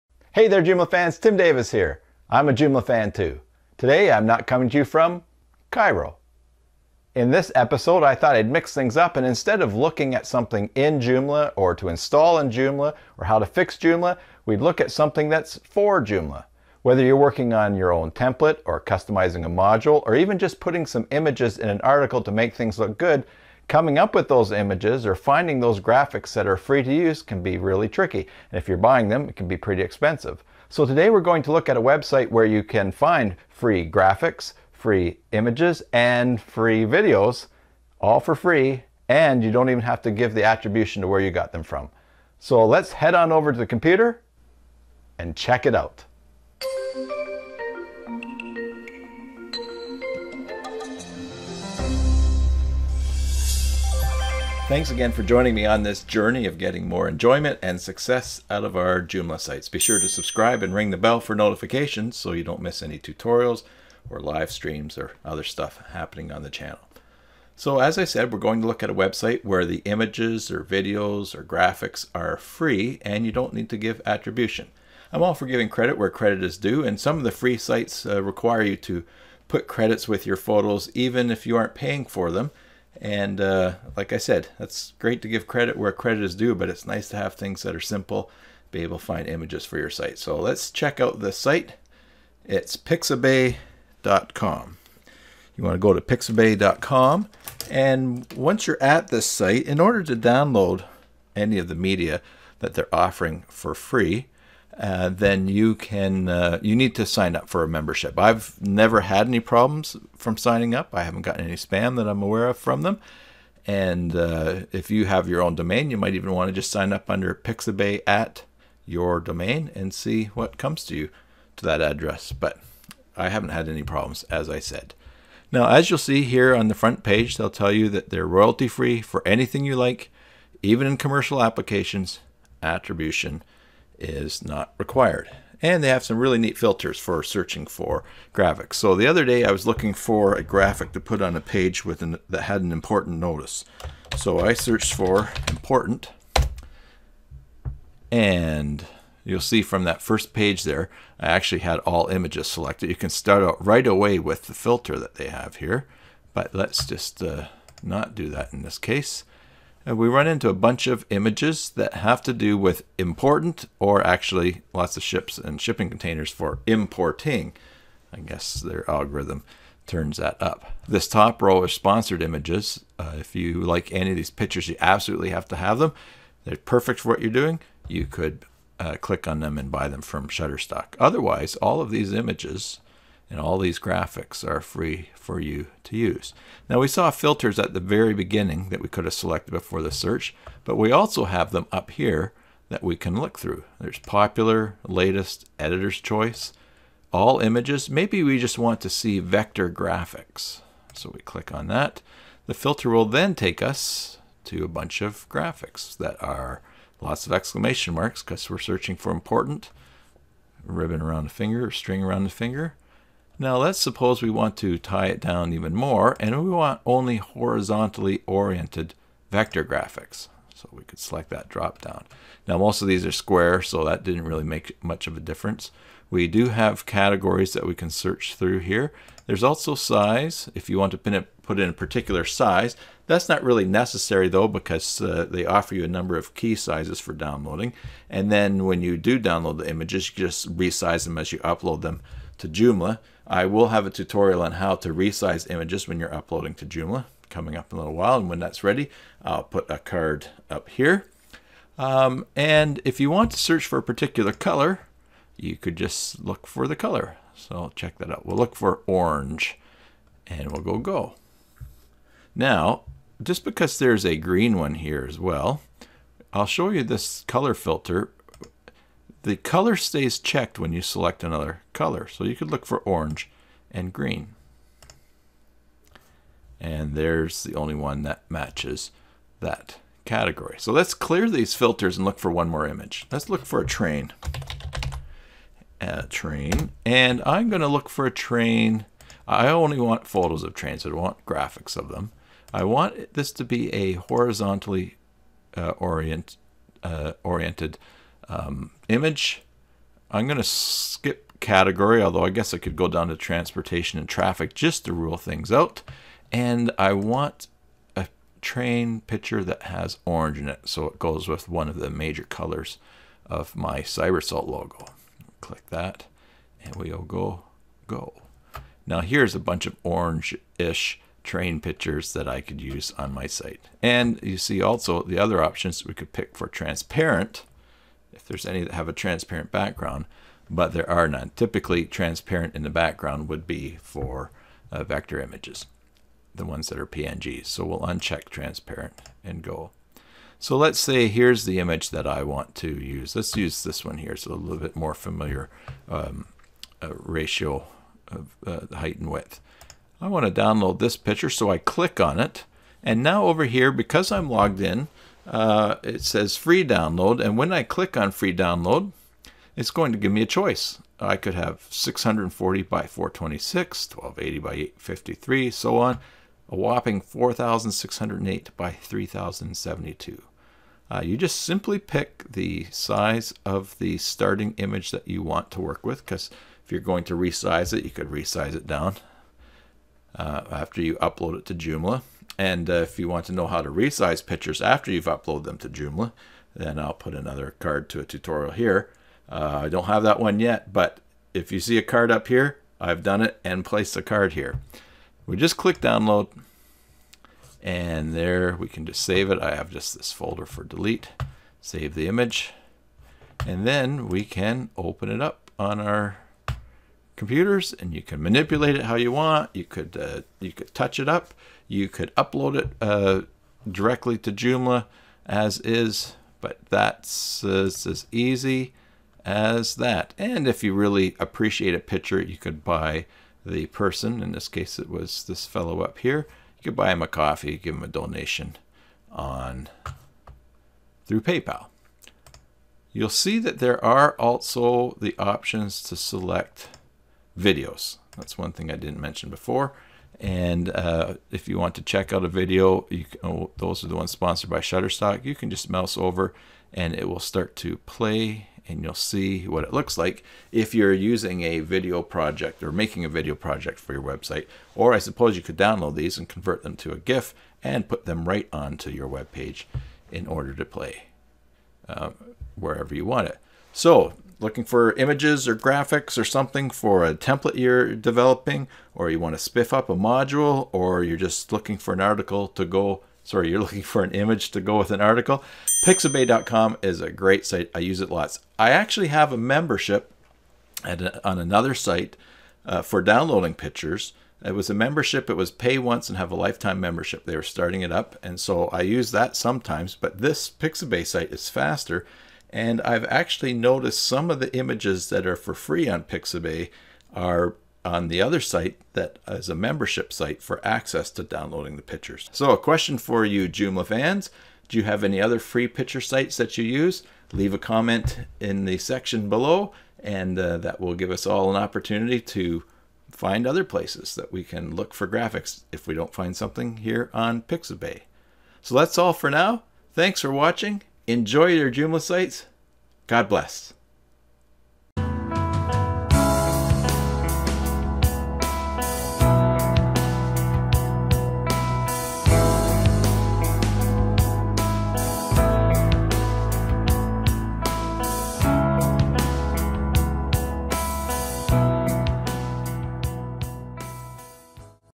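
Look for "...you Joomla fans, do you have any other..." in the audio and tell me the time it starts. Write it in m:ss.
8:23.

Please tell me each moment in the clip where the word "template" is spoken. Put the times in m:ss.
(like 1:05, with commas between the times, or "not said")
0:18, 7:47.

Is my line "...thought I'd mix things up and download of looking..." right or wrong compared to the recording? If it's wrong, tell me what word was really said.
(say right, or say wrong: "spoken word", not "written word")
wrong: "instead", not "download".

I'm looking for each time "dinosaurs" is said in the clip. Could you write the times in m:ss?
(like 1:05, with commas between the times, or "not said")
not said.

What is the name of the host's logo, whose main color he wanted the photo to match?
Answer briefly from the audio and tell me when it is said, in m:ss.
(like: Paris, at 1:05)
Cybersalt, at 5:13.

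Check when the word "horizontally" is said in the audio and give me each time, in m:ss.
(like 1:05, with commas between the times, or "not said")
3:37, 4:53.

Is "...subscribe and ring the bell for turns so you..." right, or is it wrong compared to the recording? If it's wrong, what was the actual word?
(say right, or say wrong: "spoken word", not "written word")
wrong: "notifications", not "turns".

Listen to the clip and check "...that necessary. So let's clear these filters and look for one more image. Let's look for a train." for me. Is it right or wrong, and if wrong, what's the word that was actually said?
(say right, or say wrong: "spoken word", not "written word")
wrong: "category", not "necessary".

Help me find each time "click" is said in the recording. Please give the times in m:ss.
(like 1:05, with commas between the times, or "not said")
2:58, 3:21, 5:15, 5:51, 5:57, 6:35.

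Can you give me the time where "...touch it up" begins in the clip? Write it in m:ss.
6:50.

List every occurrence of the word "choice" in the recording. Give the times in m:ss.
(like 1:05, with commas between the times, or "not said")
3:16, 6:00.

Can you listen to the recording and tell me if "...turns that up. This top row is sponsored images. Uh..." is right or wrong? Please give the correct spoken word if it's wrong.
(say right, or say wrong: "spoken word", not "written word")
right.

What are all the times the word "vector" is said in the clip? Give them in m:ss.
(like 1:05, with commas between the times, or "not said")
3:19, 3:39, 5:34.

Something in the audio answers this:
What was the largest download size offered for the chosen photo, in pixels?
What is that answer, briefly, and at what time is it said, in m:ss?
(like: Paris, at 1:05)
4608 by 3072, at 6:07.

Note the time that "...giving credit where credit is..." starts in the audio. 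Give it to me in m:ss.
1:15.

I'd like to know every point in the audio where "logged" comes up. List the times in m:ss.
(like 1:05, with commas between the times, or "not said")
5:54.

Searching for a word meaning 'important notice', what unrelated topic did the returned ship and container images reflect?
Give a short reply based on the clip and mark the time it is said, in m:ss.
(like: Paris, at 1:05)
importing, at 2:46.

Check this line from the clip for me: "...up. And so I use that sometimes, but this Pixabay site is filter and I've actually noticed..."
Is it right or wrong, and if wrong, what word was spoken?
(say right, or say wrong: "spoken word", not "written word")
wrong: "faster", not "filter".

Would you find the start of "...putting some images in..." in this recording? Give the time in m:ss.
0:20.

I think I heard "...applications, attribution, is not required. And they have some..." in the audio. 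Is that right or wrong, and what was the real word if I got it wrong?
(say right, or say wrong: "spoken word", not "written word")
right.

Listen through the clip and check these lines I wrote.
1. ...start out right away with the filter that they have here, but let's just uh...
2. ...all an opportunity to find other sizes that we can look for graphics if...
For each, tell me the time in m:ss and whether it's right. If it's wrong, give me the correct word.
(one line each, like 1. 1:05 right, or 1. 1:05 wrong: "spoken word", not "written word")
1. 2:33 right
2. 8:31 wrong: "places", not "sizes".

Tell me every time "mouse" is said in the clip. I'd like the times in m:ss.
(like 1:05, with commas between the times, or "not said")
7:25.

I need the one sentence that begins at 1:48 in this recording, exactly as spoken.
I've never had any problems from signing up.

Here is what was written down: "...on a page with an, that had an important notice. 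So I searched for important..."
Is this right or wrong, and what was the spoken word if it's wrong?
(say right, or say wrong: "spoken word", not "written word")
right.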